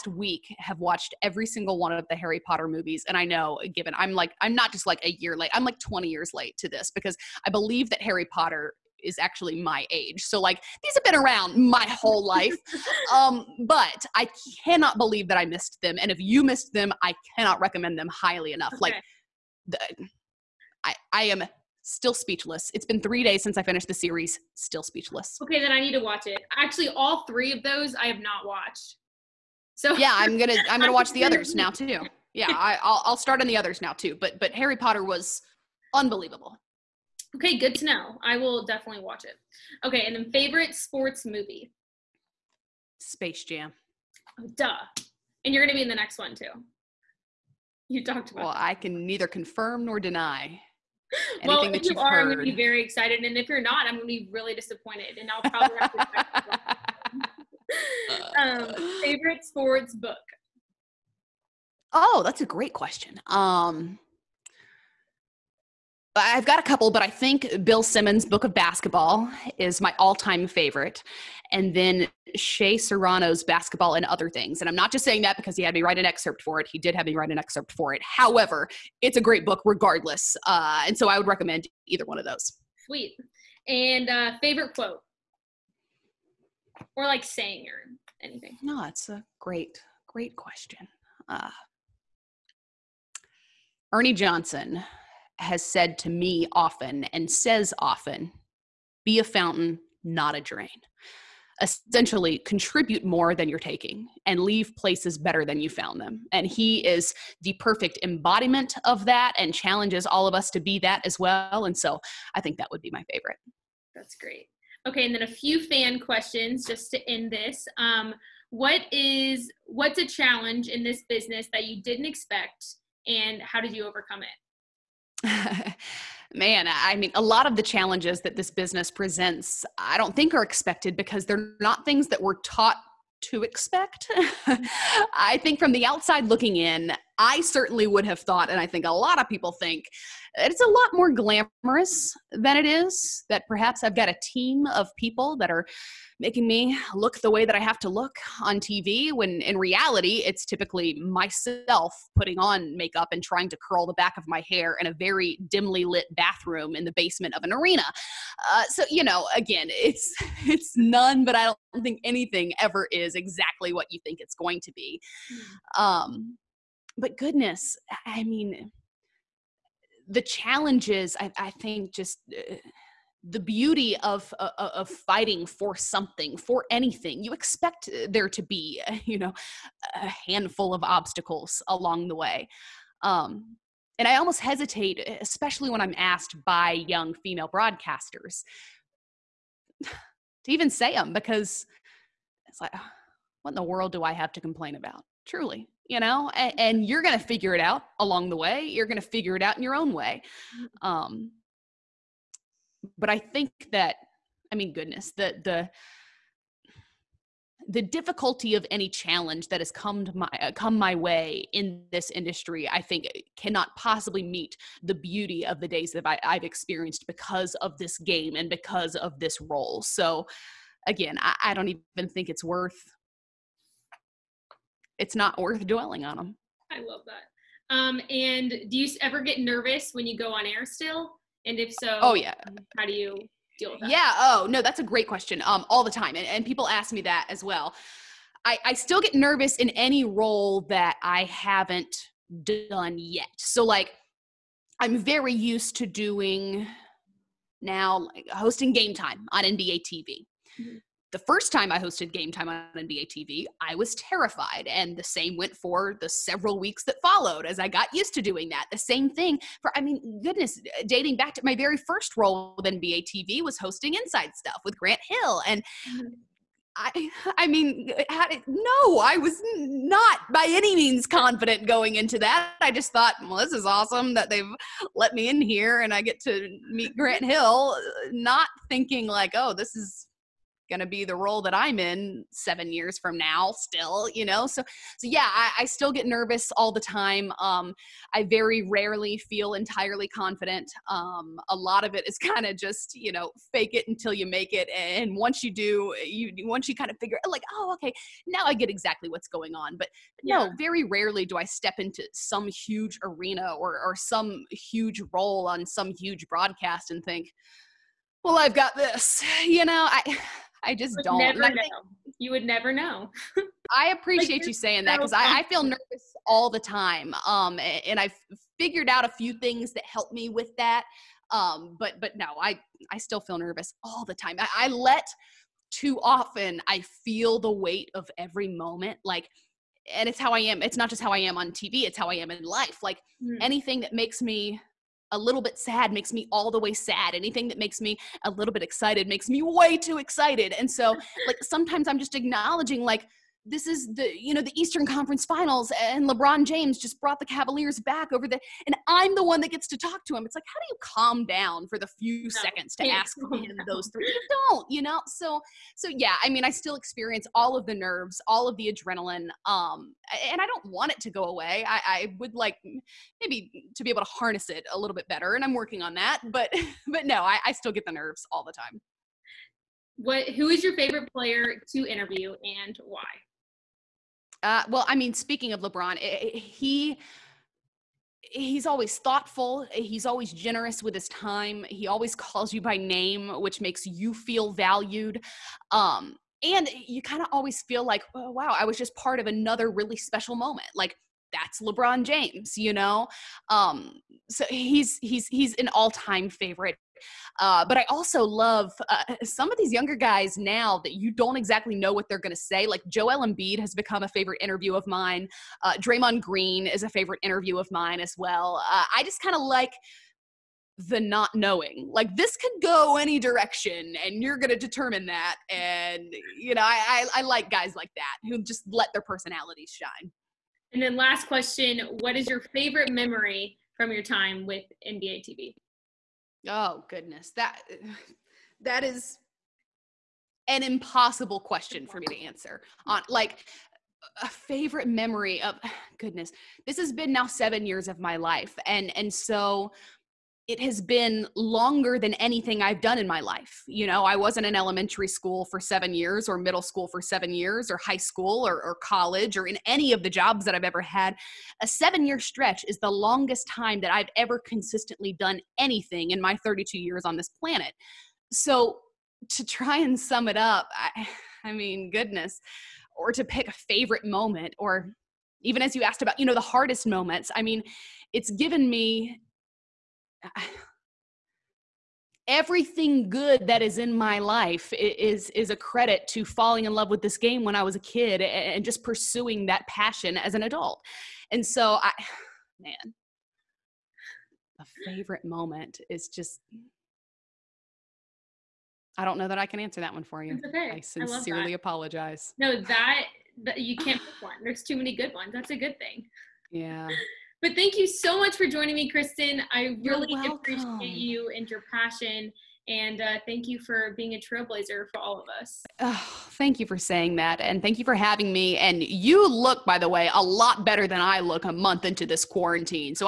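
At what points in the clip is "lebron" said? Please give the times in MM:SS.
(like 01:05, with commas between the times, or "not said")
05:46, 06:15, 06:31.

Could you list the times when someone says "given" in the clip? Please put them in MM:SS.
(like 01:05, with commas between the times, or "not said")
00:03, 07:48.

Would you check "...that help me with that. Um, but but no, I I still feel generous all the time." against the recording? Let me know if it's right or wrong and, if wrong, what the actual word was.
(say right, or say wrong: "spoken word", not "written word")
wrong: "nervous", not "generous".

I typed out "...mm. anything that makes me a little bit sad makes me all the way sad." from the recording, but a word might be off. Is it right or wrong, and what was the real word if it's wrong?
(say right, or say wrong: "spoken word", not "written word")
right.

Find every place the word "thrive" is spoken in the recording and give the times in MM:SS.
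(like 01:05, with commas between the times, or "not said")
not said.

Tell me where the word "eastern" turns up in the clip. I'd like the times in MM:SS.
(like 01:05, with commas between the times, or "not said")
05:44.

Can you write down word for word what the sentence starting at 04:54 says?
And once you do, eh, you, once you kind of figure like, oh, okay, now I get exactly what's going on.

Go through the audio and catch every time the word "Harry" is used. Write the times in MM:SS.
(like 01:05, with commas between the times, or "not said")
00:02, 00:08, 00:34.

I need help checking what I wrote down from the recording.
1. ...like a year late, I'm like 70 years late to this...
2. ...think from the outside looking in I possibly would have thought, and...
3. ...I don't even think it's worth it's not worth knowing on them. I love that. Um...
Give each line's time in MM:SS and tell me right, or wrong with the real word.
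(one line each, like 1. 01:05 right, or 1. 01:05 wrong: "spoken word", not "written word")
1. 00:04 wrong: "20", not "70"
2. 02:15 wrong: "certainly", not "possibly"
3. 03:41 wrong: "dwelling", not "knowing".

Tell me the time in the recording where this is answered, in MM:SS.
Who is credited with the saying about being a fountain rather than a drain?
01:33.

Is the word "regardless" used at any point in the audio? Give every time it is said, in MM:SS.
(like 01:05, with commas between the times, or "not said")
01:19.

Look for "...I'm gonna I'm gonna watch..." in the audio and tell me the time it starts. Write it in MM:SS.
00:30.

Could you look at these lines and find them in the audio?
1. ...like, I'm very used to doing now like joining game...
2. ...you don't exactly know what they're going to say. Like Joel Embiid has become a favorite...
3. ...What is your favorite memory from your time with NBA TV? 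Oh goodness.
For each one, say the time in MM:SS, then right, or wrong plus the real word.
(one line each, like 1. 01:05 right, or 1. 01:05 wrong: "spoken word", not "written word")
1. 04:03 wrong: "hosting", not "joining"
2. 06:40 right
3. 07:02 right.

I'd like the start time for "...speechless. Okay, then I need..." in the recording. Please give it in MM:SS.
00:24.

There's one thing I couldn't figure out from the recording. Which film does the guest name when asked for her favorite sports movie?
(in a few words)
Space Jam.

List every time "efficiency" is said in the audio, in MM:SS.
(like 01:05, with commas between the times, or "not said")
not said.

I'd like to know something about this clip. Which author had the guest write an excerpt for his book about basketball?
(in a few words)
Shea Serrano.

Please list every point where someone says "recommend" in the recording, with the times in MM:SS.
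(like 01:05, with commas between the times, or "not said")
00:17, 01:21.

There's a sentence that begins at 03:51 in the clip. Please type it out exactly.
And if so, oh yeah, how do you deal with that?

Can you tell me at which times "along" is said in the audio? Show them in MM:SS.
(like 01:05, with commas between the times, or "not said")
03:01, 03:17.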